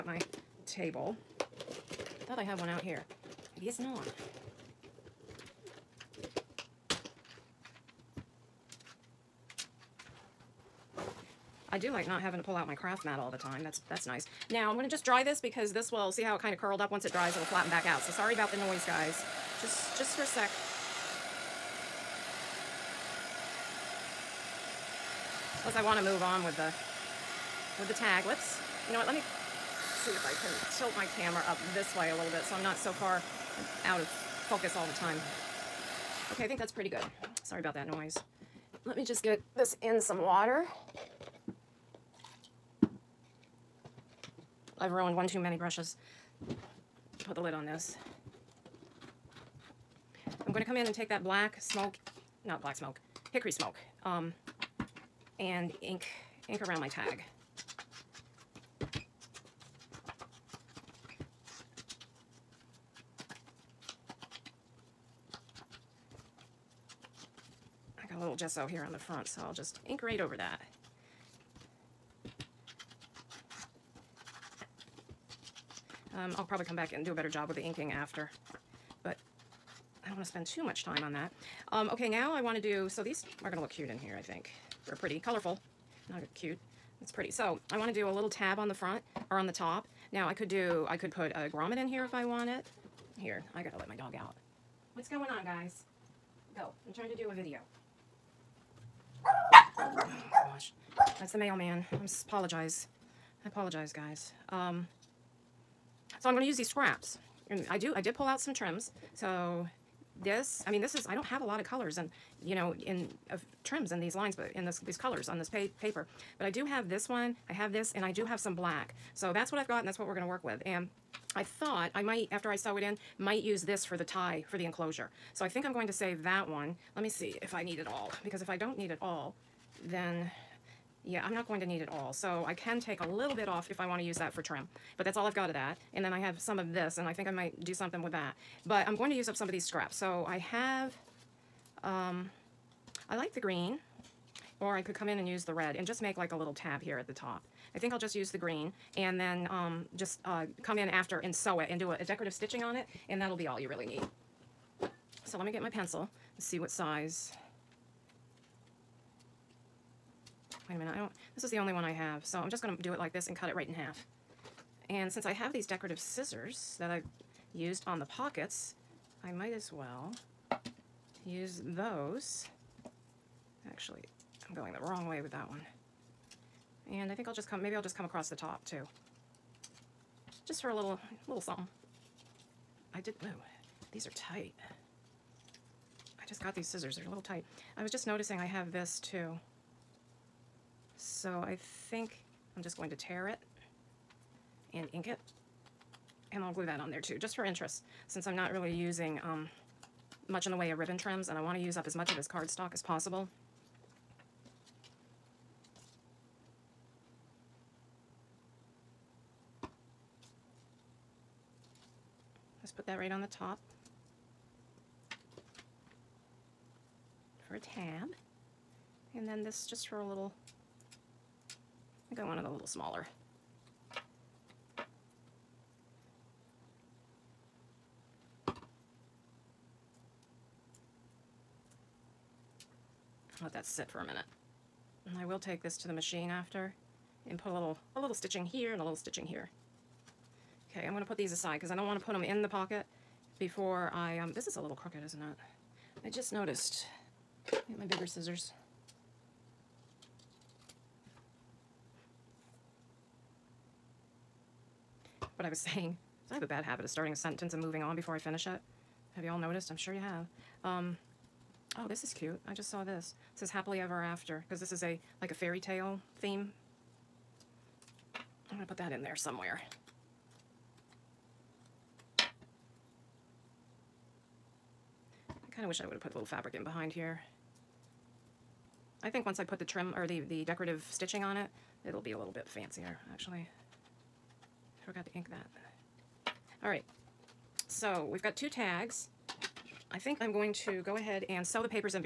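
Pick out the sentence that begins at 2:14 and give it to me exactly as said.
But that's all I've got of that.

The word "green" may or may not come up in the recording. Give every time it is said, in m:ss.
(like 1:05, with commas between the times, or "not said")
2:23, 2:28.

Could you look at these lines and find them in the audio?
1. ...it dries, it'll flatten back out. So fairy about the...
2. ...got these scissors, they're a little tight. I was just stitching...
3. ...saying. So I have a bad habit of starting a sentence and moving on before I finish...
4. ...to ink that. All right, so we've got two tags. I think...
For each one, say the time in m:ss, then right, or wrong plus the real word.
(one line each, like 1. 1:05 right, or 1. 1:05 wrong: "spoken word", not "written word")
1. 0:17 wrong: "sorry", not "fairy"
2. 3:06 wrong: "noticing", not "stitching"
3. 4:15 right
4. 4:45 right.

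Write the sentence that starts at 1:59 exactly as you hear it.
So that's what I've got, and that's what we're gonna work with.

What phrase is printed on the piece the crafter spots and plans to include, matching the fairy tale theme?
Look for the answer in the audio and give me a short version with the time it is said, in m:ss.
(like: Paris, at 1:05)
Happily ever after, at 4:23.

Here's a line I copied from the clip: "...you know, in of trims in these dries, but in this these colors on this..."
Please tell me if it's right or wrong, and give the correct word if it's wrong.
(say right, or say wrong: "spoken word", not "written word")
wrong: "lines", not "dries".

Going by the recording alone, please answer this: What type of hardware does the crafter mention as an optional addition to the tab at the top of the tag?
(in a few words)
A grommet.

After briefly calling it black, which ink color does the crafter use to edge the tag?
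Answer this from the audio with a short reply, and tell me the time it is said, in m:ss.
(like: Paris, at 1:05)
Hickory smoke, at 0:53.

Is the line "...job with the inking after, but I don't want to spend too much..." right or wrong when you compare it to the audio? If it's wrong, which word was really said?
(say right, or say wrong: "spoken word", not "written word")
right.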